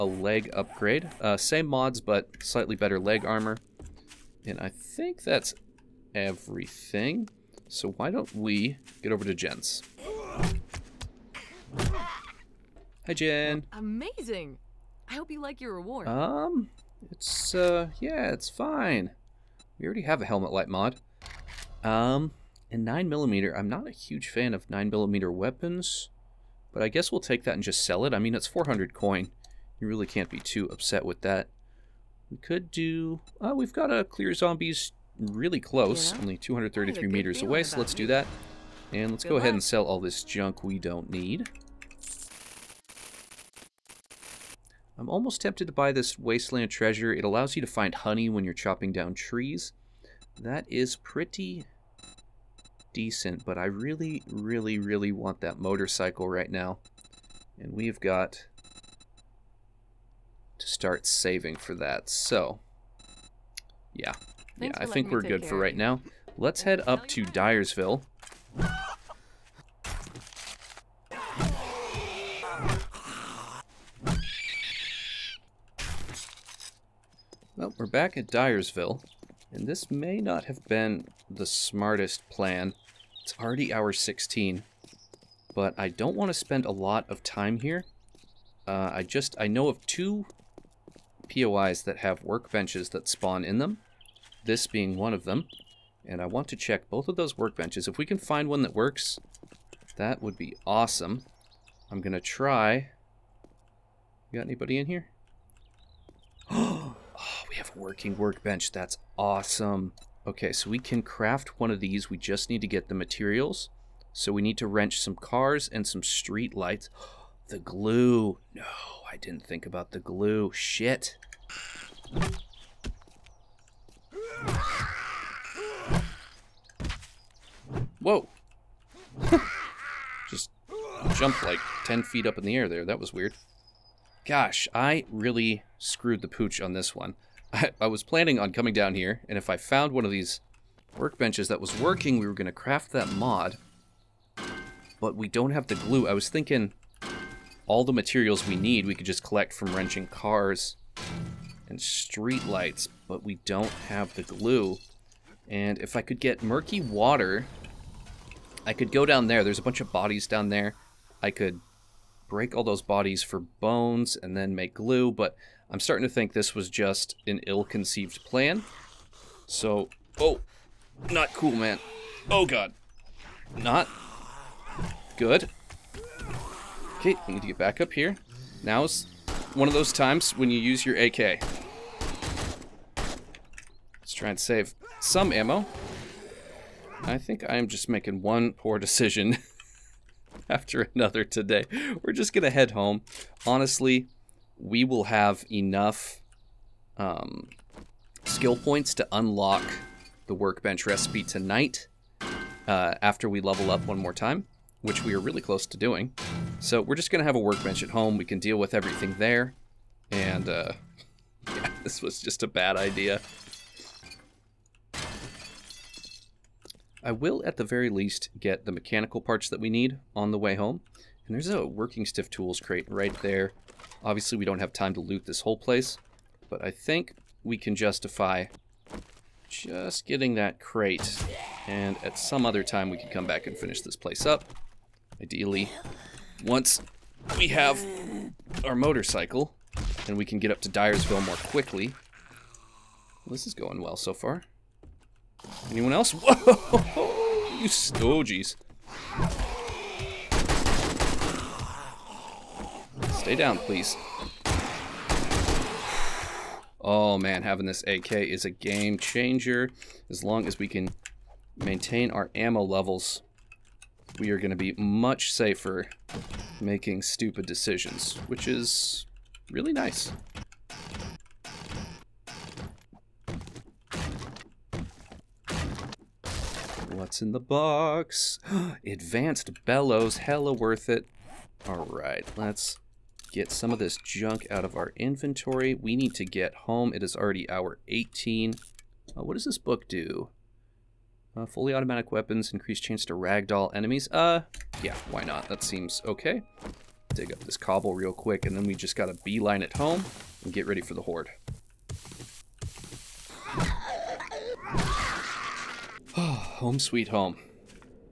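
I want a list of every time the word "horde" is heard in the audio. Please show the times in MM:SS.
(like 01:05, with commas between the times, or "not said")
05:01.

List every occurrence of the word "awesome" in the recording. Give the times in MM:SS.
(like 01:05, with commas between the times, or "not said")
01:40, 01:49.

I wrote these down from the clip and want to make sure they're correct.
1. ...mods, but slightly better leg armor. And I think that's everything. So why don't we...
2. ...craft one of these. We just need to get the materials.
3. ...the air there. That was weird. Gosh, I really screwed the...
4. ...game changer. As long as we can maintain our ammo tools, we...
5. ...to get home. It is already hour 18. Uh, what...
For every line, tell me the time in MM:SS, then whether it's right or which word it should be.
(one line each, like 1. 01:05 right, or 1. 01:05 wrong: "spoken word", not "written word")
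1. 00:01 right
2. 01:51 right
3. 02:12 right
4. 04:18 wrong: "levels", not "tools"
5. 04:46 right.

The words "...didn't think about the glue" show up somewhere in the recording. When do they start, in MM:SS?
01:59.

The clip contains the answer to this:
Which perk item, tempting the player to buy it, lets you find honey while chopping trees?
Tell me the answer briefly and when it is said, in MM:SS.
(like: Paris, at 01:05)
Wasteland Treasure, at 00:46.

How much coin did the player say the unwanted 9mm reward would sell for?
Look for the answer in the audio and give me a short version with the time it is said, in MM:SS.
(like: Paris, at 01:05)
400, at 00:28.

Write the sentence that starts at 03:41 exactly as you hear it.
And there's a working stiff tools crate right there.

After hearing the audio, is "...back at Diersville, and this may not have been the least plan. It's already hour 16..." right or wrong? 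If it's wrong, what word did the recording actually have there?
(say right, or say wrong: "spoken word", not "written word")
wrong: "smartest", not "least".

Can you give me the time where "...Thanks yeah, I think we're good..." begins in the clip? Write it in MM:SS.
01:04.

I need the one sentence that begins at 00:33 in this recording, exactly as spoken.
Uh, we've got a Clear Zombies really close, yeah.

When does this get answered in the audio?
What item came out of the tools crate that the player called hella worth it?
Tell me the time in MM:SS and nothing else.
04:38.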